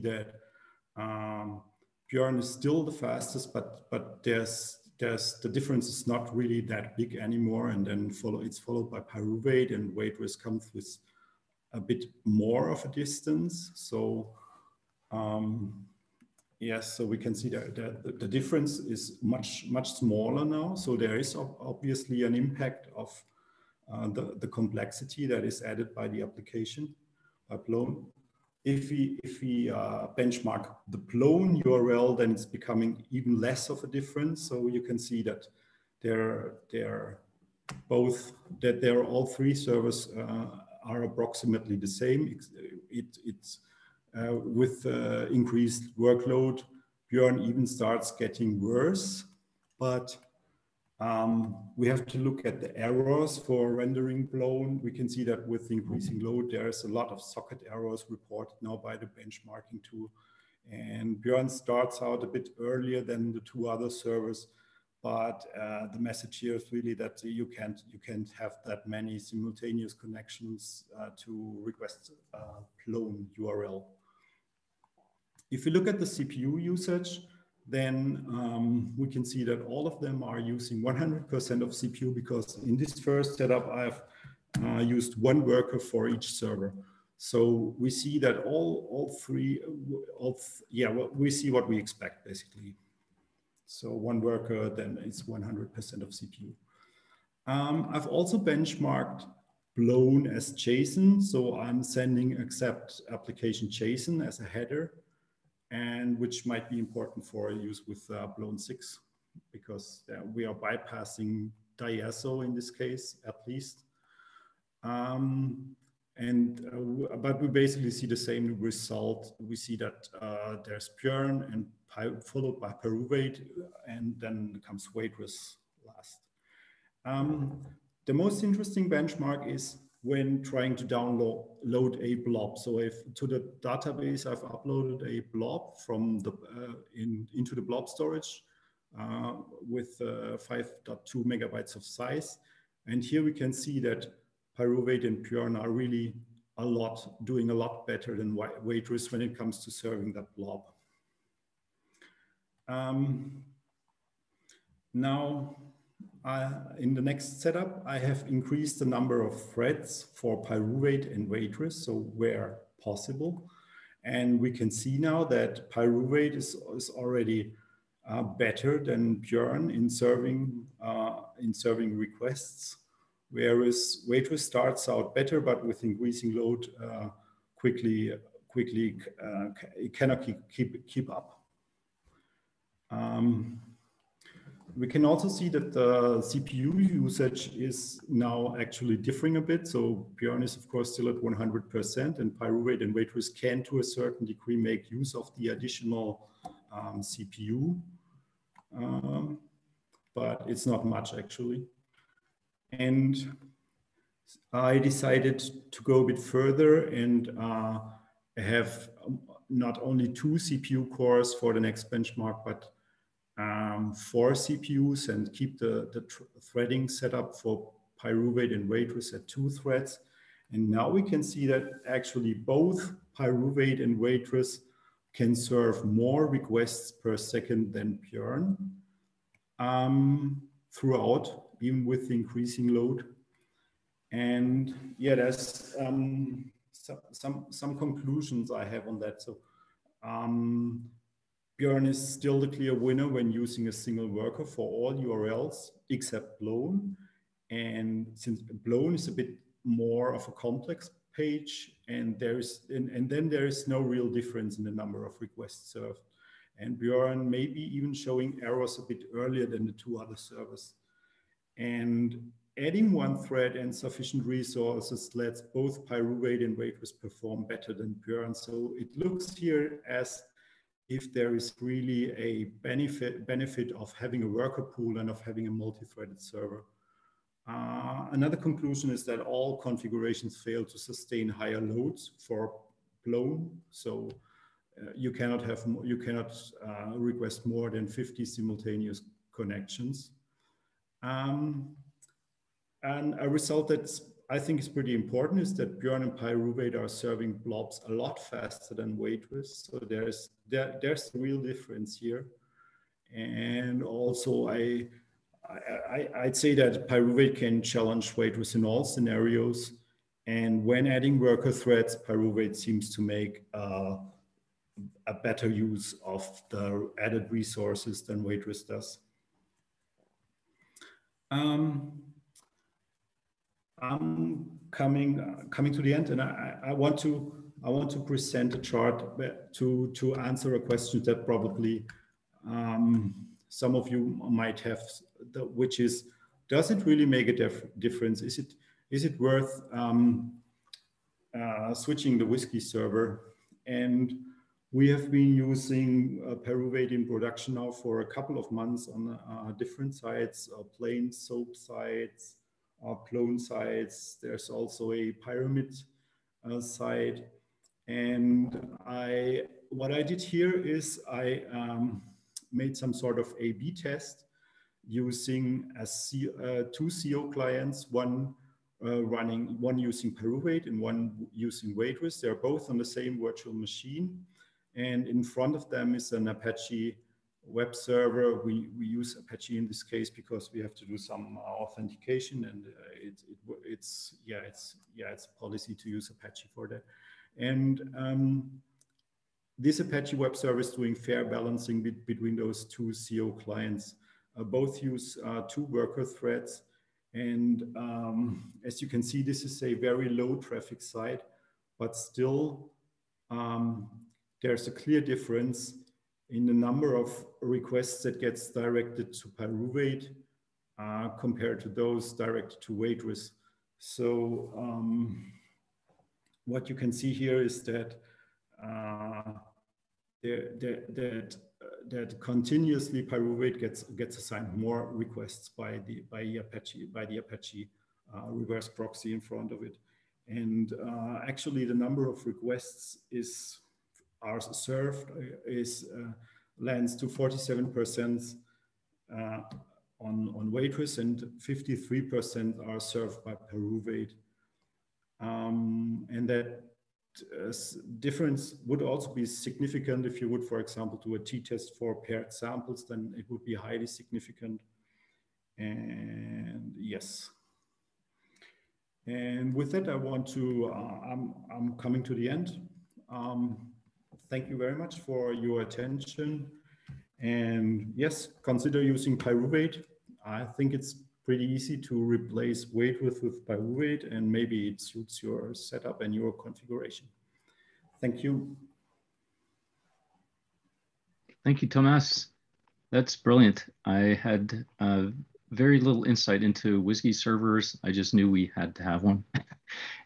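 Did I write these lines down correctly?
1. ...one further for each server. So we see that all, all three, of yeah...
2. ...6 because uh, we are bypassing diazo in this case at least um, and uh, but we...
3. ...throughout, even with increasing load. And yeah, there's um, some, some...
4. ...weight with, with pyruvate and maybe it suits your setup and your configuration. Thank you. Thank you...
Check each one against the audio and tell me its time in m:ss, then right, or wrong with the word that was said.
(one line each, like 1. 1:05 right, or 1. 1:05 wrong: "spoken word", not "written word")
1. 1:25 wrong: "worker", not "further"
2. 1:48 right
3. 3:50 right
4. 7:52 right.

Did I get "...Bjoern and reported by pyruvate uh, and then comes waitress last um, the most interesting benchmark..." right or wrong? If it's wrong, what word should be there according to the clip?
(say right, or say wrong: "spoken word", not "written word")
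wrong: "followed", not "reported".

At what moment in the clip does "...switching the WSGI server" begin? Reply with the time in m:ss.
5:41.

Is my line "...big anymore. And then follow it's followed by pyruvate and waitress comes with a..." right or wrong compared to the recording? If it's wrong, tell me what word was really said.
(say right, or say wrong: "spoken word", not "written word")
right.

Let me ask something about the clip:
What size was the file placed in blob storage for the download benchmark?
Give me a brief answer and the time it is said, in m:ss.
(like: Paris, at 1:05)
5.2 megabytes, at 2:20.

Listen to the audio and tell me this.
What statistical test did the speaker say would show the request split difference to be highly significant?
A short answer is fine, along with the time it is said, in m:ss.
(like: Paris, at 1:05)
t-test for paired samples, at 7:31.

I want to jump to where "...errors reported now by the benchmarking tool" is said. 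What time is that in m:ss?
0:57.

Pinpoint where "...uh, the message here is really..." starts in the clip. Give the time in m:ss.
1:05.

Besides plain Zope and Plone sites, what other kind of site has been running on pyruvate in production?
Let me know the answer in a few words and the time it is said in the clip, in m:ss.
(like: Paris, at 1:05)
Pyramid, at 5:55.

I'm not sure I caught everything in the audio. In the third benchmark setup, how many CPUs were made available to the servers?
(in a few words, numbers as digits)
4.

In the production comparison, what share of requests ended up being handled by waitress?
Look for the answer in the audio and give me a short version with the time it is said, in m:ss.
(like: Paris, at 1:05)
47%, at 7:17.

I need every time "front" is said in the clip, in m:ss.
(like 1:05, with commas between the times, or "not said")
6:15, 7:09.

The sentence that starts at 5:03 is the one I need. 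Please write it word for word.
And also I, I, I'd say that pyruvate can challenge waitress in all scenarios.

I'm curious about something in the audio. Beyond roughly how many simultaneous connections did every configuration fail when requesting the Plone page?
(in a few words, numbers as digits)
50.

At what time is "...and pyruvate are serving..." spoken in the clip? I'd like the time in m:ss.
4:56.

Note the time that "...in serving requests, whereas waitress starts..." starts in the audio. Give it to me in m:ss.
2:51.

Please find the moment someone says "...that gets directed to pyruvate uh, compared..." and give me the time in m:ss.
6:48.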